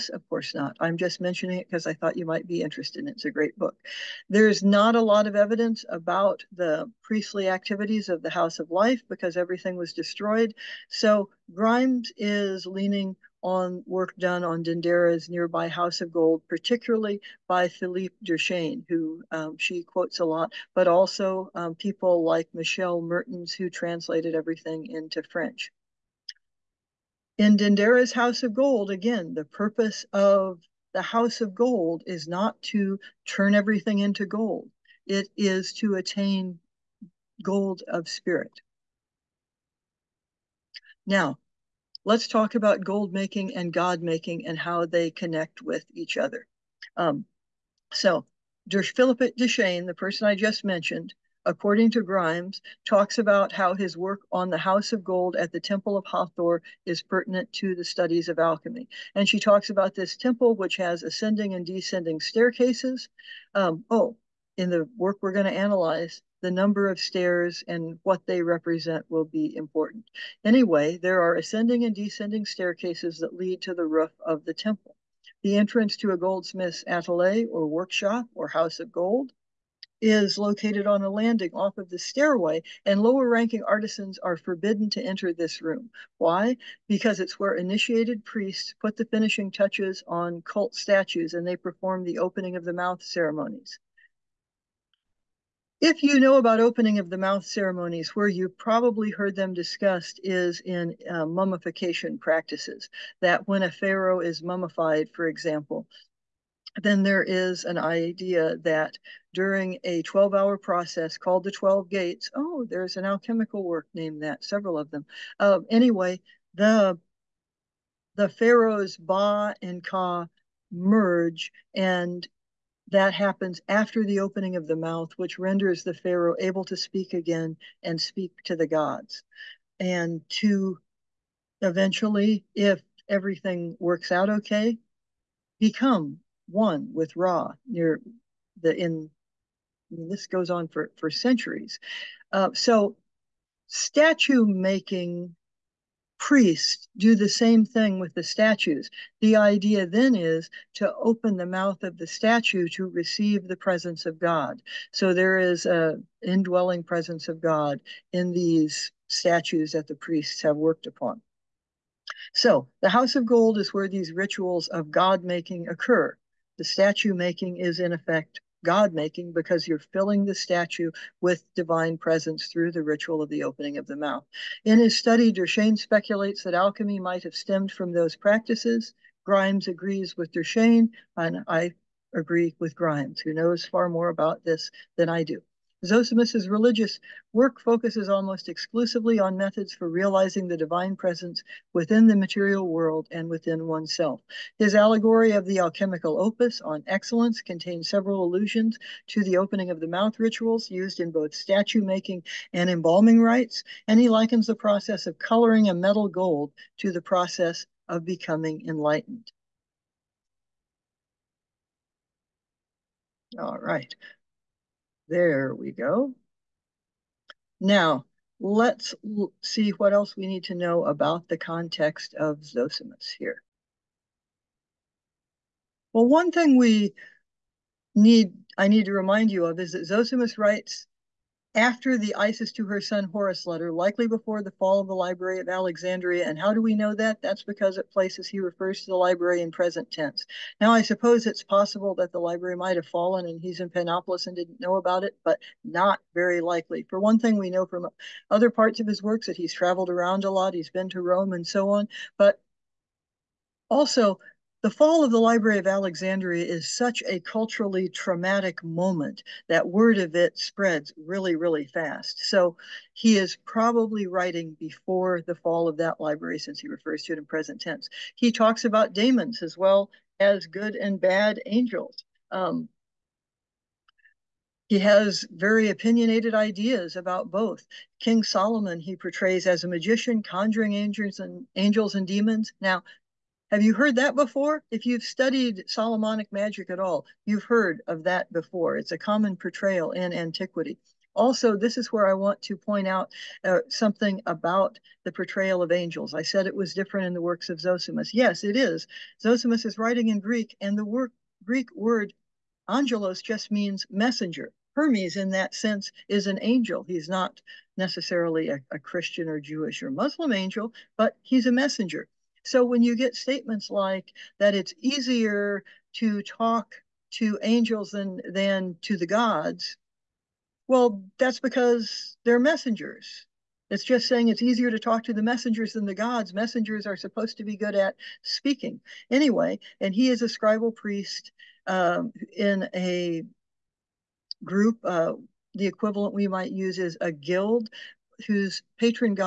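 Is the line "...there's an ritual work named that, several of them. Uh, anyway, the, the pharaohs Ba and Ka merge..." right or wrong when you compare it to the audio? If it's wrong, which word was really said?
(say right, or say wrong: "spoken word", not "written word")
wrong: "alchemical", not "ritual".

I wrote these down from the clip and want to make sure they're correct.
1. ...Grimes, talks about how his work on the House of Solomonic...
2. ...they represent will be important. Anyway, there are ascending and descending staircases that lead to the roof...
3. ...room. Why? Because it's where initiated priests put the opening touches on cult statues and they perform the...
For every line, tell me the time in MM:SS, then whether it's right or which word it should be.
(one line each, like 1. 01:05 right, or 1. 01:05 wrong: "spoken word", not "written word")
1. 00:52 wrong: "Gold", not "Solomonic"
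2. 01:08 right
3. 01:25 wrong: "finishing", not "opening".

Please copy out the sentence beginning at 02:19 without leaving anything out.
I mean, this goes on for for centuries.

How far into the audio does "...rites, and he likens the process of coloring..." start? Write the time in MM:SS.
03:23.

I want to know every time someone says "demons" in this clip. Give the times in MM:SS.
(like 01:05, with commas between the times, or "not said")
04:28, 04:42.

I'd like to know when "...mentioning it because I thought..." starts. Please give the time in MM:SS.
00:01.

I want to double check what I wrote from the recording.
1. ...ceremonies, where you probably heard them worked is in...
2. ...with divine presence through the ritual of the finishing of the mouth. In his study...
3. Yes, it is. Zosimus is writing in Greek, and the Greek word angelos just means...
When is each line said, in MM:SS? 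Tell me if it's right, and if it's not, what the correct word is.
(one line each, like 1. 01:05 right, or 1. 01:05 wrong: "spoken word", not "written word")
1. 01:37 wrong: "discussed", not "worked"
2. 02:51 wrong: "opening", not "finishing"
3. 04:58 right.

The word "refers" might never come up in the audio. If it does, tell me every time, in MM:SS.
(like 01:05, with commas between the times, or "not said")
03:58, 04:26.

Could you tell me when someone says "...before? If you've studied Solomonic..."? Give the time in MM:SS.
04:44.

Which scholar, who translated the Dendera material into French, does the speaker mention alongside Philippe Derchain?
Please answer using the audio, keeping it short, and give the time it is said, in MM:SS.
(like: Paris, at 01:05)
Michelle Mertens, at 00:22.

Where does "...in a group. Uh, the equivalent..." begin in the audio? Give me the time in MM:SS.
05:32.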